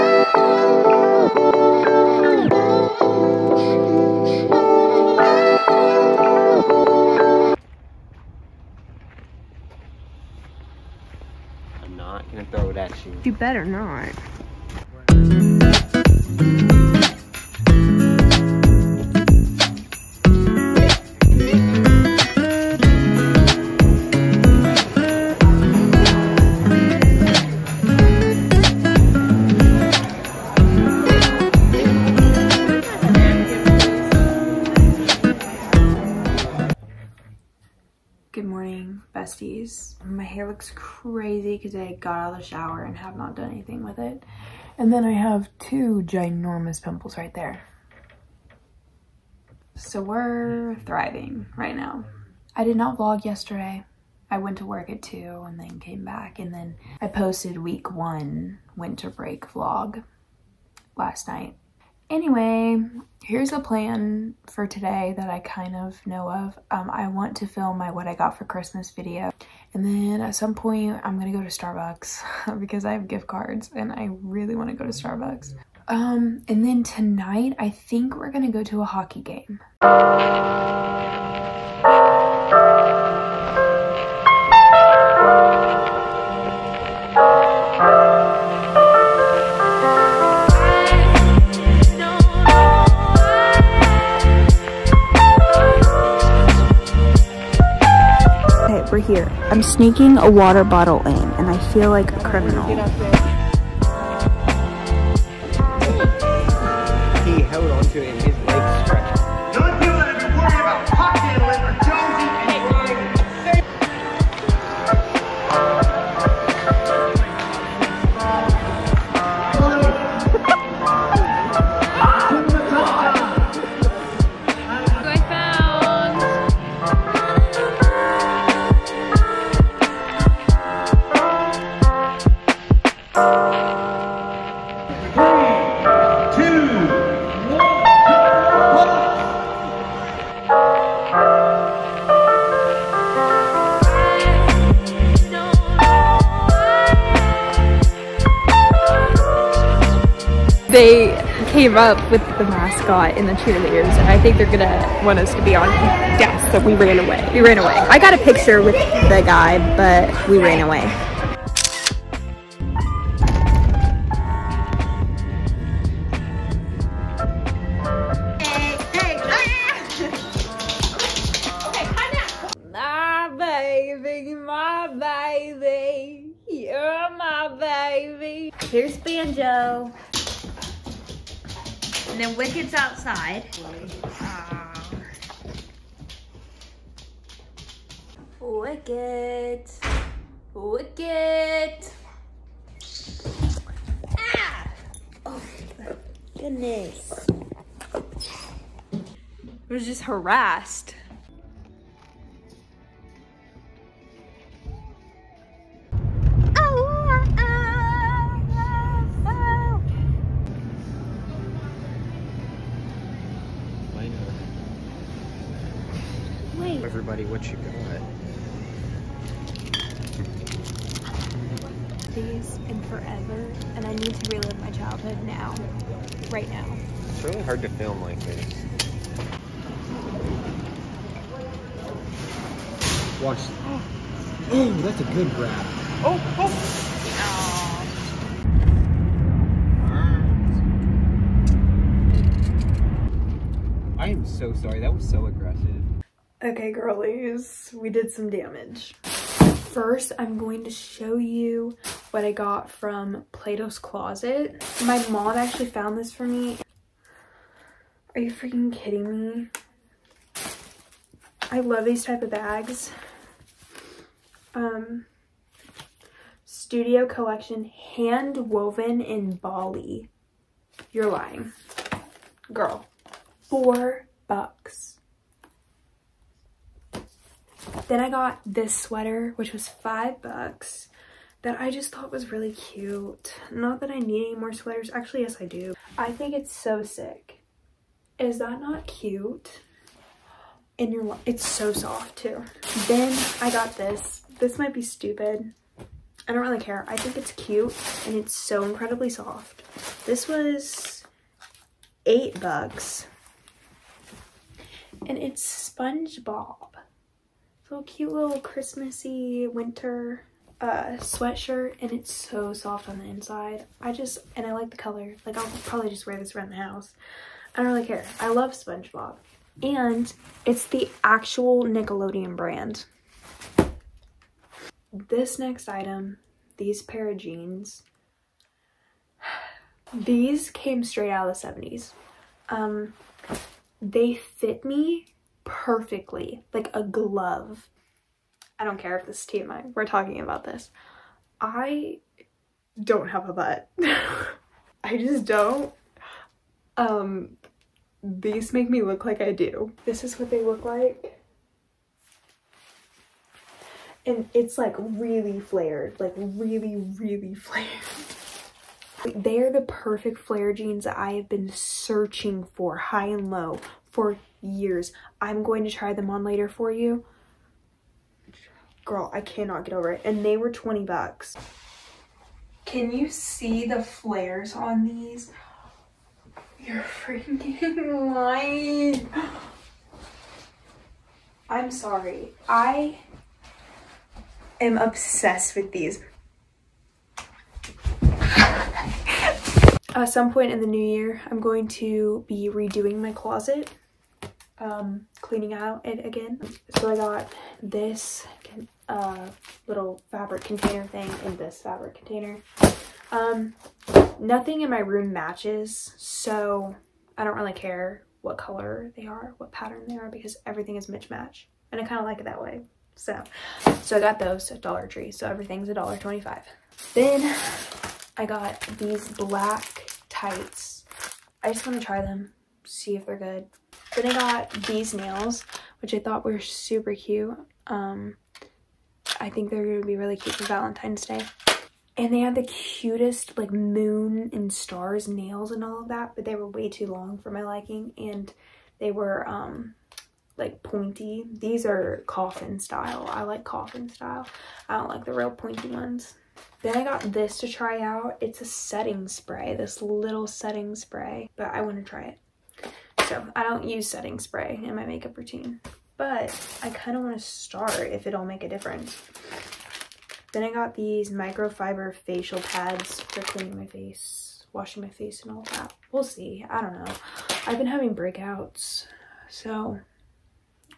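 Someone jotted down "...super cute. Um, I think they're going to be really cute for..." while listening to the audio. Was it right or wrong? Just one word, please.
right.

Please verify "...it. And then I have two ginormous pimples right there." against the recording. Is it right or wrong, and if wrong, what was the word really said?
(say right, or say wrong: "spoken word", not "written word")
right.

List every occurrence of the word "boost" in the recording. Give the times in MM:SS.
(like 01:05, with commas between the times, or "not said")
not said.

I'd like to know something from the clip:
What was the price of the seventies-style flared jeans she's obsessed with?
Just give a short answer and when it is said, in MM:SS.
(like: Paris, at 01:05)
20 dollars, at 06:10.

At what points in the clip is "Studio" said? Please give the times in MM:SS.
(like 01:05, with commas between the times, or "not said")
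04:26.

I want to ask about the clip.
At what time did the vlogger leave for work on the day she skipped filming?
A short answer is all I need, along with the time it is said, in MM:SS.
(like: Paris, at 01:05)
2, at 00:55.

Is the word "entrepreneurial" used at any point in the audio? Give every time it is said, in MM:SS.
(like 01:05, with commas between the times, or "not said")
not said.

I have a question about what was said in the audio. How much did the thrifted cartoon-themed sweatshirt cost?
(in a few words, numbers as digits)
8 dollars.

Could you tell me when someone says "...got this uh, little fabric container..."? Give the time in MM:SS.
06:36.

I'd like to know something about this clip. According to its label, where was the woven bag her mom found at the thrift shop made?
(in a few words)
Bali.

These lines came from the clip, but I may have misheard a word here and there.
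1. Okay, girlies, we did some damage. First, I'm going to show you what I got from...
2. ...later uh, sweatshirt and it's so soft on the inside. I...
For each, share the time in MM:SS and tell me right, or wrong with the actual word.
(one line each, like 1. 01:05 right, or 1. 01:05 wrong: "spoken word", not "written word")
1. 04:06 right
2. 05:09 wrong: "winter", not "later".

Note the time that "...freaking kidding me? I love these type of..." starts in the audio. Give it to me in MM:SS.
04:18.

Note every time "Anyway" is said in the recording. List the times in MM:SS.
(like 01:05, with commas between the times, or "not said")
01:02.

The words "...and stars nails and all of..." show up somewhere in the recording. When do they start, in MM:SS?
07:14.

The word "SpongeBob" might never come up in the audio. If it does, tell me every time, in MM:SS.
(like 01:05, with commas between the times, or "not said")
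05:05, 05:18.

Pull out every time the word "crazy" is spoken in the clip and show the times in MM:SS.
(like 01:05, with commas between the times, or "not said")
00:40.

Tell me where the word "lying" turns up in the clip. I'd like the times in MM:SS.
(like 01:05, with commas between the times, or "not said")
04:31, 06:18.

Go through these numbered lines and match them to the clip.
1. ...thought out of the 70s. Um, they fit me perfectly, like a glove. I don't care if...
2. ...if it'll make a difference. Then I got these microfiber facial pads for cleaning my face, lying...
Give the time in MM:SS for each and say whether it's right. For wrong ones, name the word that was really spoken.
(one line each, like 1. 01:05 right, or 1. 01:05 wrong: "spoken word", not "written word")
1. 05:30 wrong: "straight", not "thought"
2. 07:37 wrong: "washing", not "lying".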